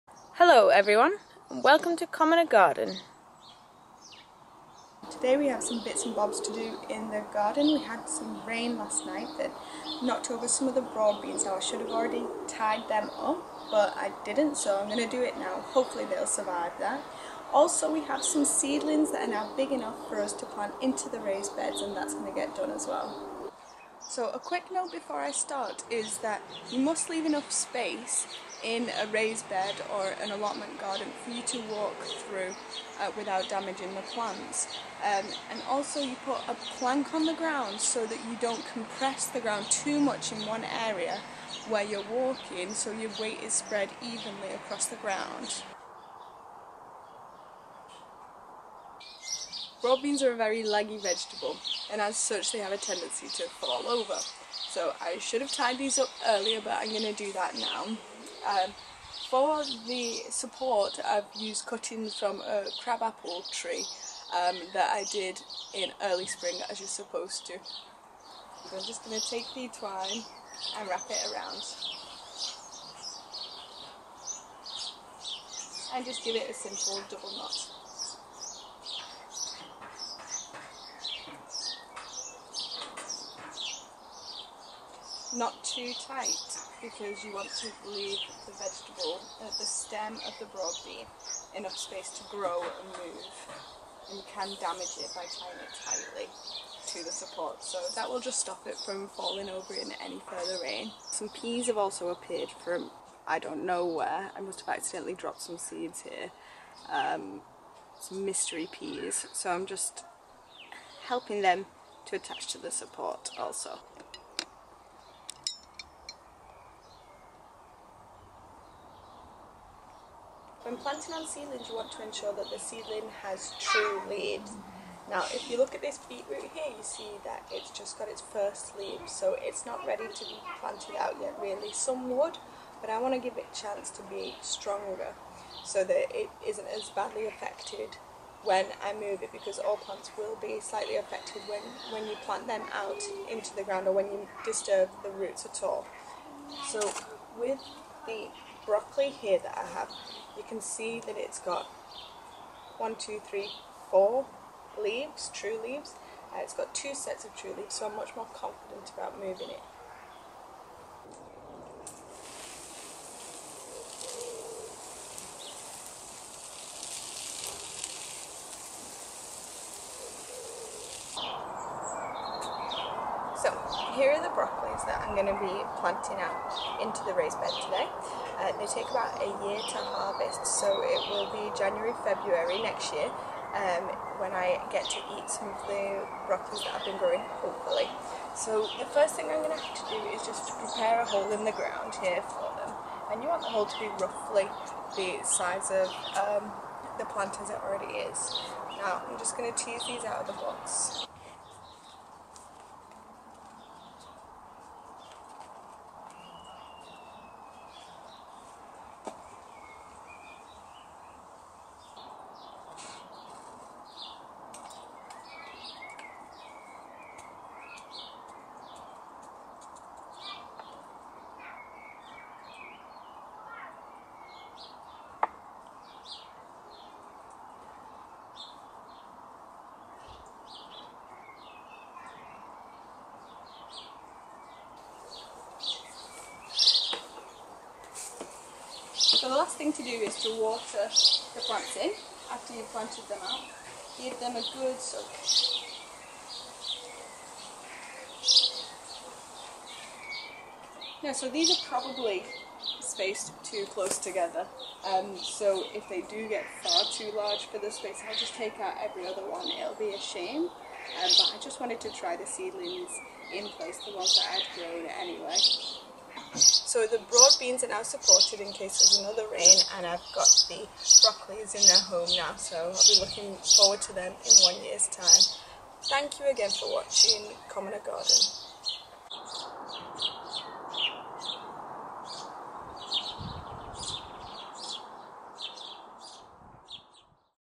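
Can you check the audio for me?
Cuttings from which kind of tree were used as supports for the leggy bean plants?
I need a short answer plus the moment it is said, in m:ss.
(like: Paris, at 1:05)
Crabapple, at 1:02.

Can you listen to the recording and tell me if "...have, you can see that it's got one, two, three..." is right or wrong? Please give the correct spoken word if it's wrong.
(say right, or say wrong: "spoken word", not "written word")
right.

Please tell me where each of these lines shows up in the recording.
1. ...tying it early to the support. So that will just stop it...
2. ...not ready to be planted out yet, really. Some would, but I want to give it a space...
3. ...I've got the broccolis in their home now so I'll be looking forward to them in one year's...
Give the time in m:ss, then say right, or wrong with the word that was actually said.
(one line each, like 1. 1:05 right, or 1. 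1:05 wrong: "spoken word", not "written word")
1. 1:35 wrong: "tightly", not "early"
2. 2:09 wrong: "chance", not "space"
3. 4:29 right.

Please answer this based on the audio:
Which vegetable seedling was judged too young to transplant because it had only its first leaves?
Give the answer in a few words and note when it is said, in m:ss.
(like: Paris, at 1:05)
Beetroot, at 2:06.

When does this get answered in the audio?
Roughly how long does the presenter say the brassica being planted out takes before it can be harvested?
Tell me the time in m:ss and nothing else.
2:58.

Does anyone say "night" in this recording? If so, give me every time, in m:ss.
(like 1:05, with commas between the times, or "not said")
0:09.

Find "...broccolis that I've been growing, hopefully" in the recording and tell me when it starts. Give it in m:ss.
3:06.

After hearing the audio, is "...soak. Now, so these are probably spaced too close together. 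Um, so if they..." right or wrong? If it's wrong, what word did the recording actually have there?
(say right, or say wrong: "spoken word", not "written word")
right.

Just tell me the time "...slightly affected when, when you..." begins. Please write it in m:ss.
2:20.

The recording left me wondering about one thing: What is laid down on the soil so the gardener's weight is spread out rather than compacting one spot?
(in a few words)
A plank.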